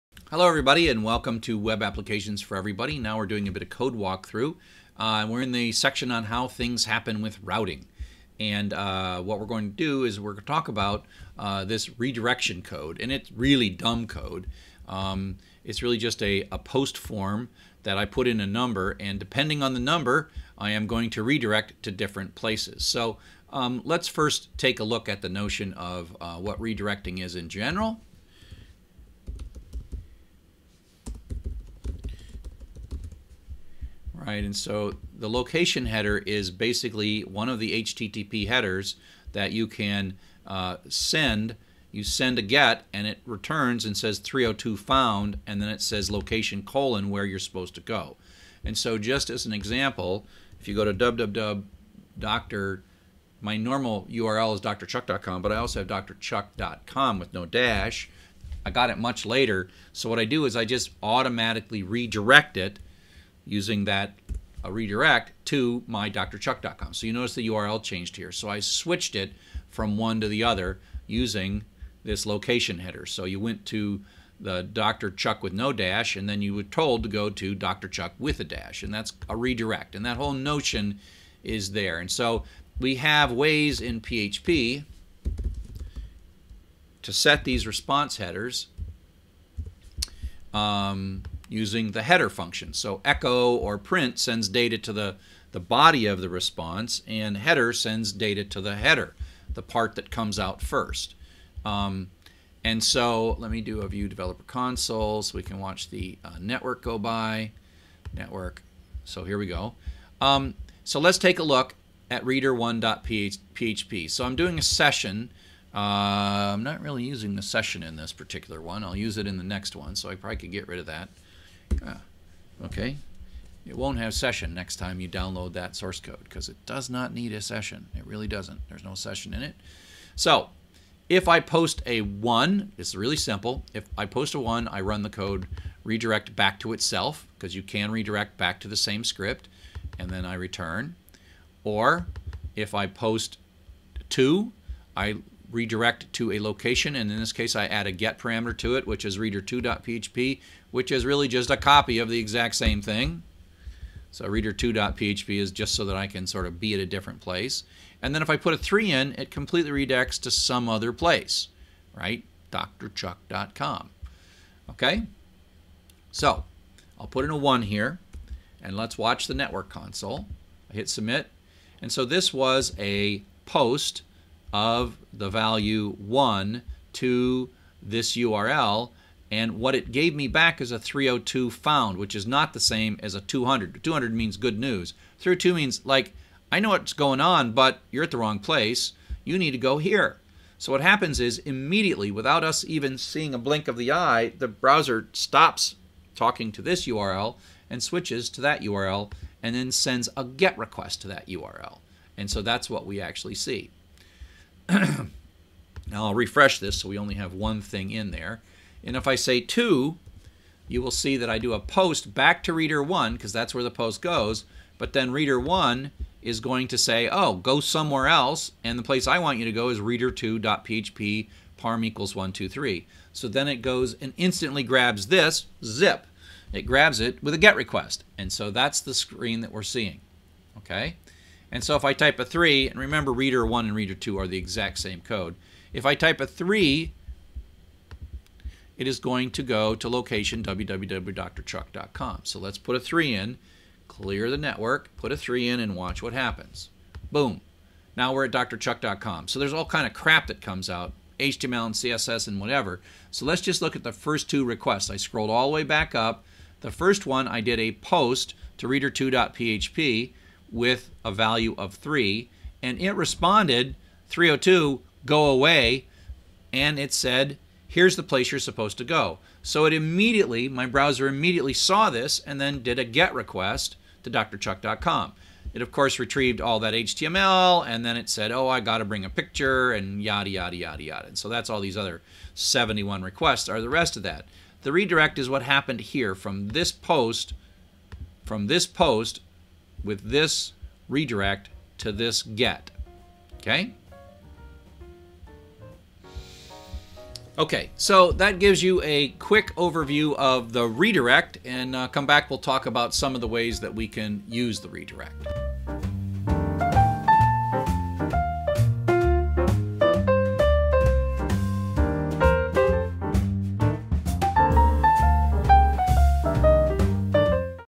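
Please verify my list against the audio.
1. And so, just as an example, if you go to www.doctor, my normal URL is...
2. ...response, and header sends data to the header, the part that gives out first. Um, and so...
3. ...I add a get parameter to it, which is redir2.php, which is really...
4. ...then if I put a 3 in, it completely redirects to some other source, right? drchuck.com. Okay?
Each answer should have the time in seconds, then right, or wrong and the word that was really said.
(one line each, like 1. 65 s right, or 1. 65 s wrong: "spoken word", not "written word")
1. 48 s right
2. 96 s wrong: "comes", not "gives"
3. 147 s right
4. 158 s wrong: "place", not "source".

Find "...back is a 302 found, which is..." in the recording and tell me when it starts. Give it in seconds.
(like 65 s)
180 s.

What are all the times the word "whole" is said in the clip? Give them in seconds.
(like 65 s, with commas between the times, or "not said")
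80 s.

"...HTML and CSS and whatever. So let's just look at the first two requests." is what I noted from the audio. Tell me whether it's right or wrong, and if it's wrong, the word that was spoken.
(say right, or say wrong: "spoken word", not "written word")
right.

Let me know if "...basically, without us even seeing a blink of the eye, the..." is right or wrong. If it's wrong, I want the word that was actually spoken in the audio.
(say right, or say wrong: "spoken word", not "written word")
wrong: "immediately", not "basically".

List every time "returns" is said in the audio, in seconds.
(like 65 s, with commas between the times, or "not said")
43 s, 140 s.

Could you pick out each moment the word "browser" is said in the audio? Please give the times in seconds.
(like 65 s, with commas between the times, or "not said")
194 s, 270 s.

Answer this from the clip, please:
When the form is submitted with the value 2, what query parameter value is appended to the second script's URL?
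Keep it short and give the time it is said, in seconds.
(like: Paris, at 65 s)
123, at 221 s.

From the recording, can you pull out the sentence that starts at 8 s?
And uh, what we're going to do is we're going to talk about uh, this redirection code.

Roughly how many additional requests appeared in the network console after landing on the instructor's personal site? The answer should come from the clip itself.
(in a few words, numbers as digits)
71.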